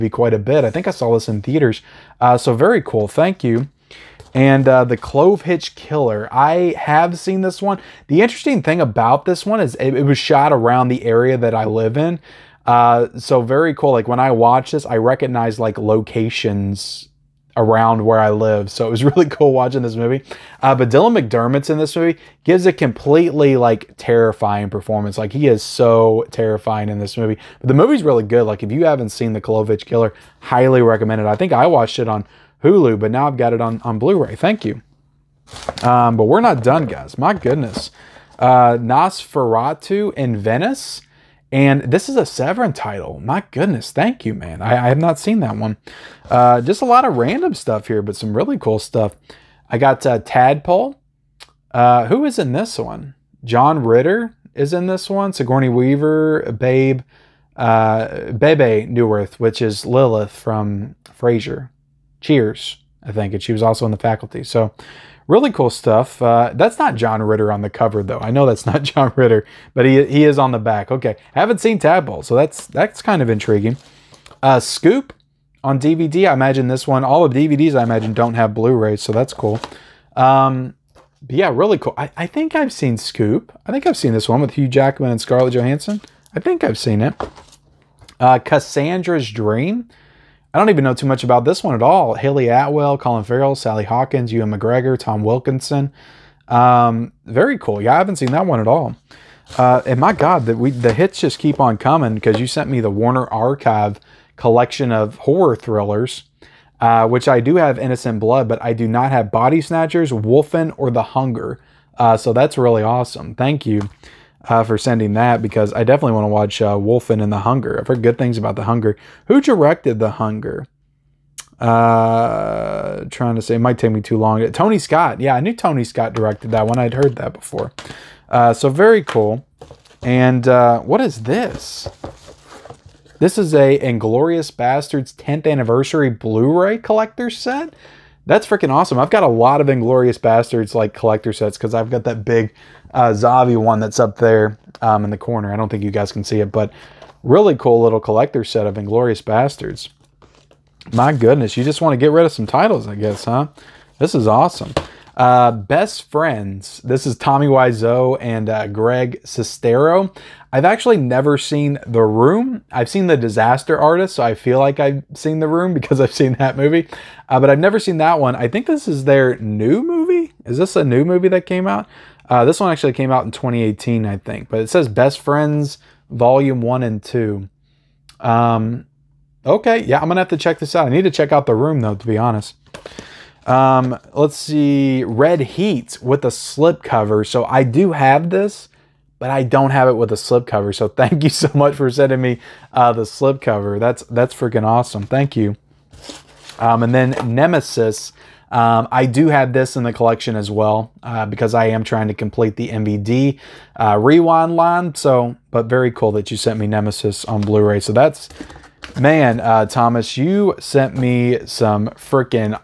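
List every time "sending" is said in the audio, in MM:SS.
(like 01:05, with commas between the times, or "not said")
01:54, 03:11.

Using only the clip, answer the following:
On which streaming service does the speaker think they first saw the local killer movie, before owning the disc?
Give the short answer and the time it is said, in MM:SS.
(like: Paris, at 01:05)
Hulu, at 00:32.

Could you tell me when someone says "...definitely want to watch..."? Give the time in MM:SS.
01:55.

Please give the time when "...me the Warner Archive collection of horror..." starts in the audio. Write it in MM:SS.
01:42.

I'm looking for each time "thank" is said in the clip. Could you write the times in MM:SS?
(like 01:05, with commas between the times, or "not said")
00:03, 00:34, 00:43, 01:53, 03:10, 03:15.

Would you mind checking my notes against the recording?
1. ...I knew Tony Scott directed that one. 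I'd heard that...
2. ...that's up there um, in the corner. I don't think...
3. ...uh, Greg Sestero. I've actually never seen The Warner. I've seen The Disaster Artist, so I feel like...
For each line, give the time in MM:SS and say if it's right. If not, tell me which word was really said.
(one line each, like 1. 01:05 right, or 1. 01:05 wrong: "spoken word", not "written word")
1. 02:05 right
2. 02:23 right
3. 02:38 wrong: "Room", not "Warner".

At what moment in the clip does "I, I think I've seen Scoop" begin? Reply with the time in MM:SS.
01:21.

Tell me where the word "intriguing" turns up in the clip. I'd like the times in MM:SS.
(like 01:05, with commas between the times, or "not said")
01:13.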